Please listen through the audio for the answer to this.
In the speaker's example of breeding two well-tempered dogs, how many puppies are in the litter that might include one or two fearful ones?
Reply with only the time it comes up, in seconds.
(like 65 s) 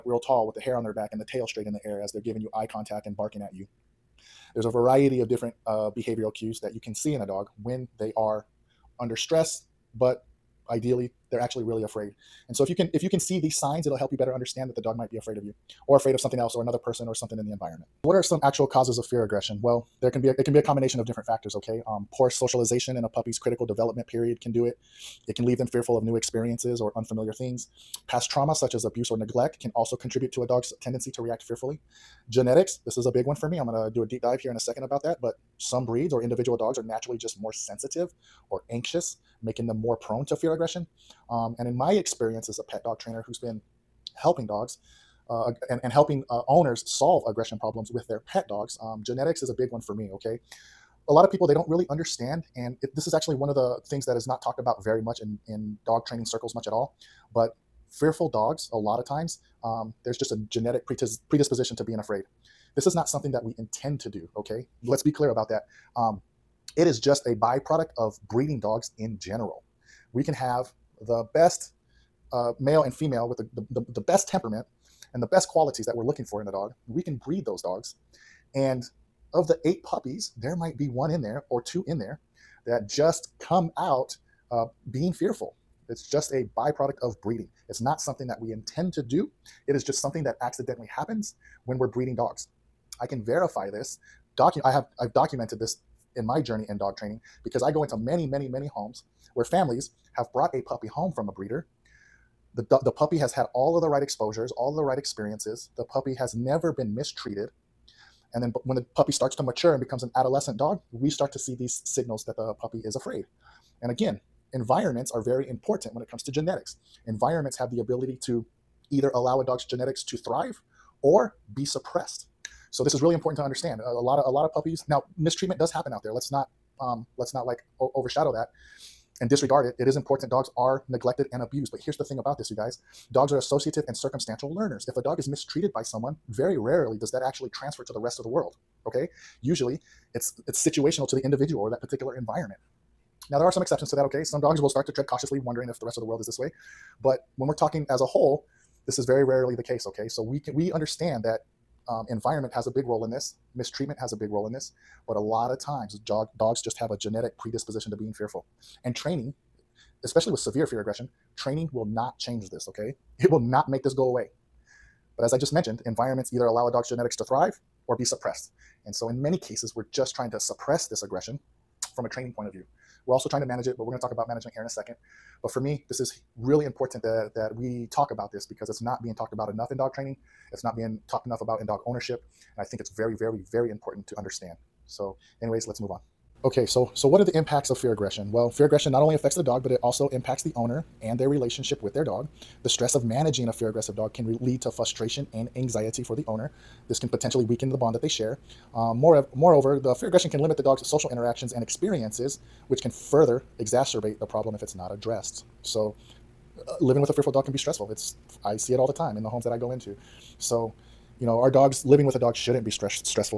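79 s.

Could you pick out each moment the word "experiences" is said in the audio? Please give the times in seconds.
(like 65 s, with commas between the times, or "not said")
26 s, 41 s, 104 s, 201 s.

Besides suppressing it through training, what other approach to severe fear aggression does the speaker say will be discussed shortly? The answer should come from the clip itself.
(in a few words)
Management.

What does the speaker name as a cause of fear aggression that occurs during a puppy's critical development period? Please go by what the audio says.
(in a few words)
Poor socialization.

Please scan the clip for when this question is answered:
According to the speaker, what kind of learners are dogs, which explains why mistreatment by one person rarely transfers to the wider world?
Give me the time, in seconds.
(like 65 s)
133 s.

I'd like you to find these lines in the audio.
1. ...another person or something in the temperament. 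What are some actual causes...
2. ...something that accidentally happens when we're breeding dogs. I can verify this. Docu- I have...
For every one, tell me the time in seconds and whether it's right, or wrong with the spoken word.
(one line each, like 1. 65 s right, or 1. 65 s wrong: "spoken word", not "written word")
1. 16 s wrong: "environment", not "temperament"
2. 90 s right.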